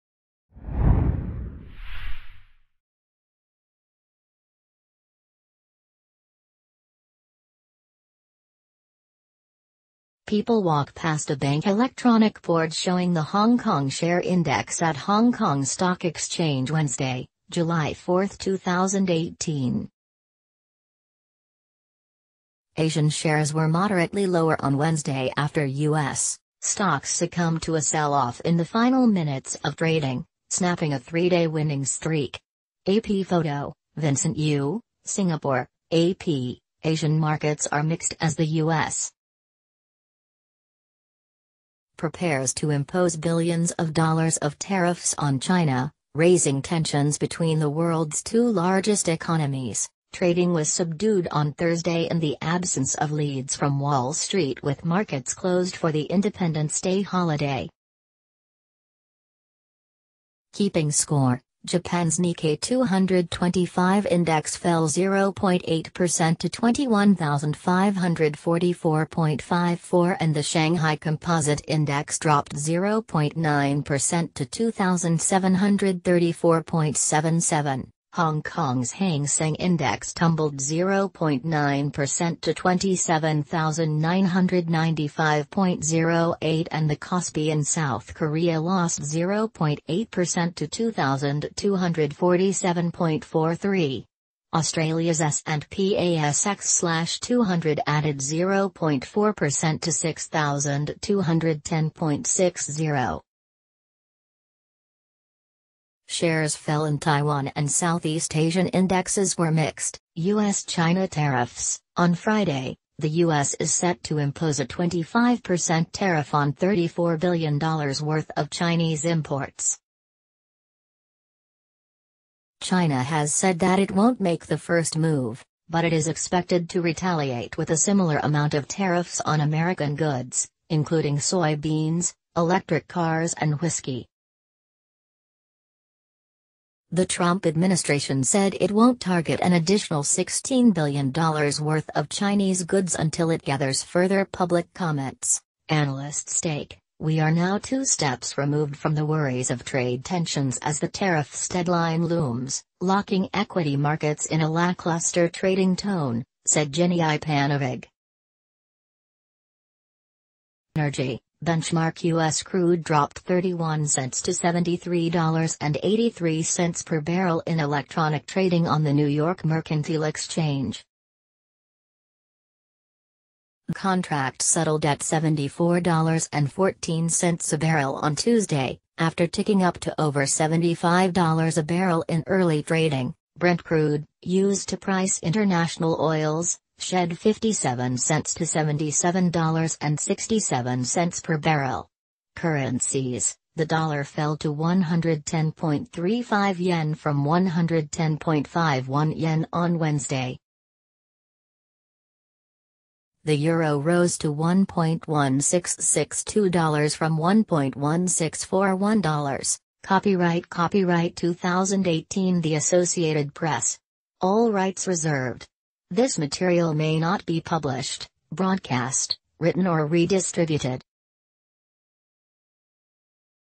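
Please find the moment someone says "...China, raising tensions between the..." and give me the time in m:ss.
0:45.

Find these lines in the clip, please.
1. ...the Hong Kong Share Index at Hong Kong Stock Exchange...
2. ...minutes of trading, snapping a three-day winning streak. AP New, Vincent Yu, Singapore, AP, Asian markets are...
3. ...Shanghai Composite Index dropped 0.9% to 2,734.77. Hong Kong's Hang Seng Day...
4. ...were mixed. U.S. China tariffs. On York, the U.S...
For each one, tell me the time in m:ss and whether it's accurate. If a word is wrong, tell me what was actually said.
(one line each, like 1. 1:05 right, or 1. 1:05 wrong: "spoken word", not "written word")
1. 0:13 right
2. 0:29 wrong: "Photo", not "New"
3. 1:10 wrong: "Index", not "Day"
4. 1:49 wrong: "Friday", not "York".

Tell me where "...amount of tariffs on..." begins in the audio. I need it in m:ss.
2:08.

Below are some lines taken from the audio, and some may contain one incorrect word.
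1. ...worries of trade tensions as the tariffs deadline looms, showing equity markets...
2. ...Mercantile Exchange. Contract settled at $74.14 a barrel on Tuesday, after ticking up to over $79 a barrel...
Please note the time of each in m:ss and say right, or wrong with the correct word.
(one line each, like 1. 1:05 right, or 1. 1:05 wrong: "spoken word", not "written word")
1. 2:29 wrong: "locking", not "showing"
2. 2:49 wrong: "75", not "79".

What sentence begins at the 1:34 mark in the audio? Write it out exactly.
Australia's S&P ASX/200 added 0.4% to 6,210.60.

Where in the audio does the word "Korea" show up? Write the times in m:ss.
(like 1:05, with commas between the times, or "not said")
1:28.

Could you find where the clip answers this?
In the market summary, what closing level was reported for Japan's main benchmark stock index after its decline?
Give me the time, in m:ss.
1:06.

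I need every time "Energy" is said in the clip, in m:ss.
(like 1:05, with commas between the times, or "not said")
2:40.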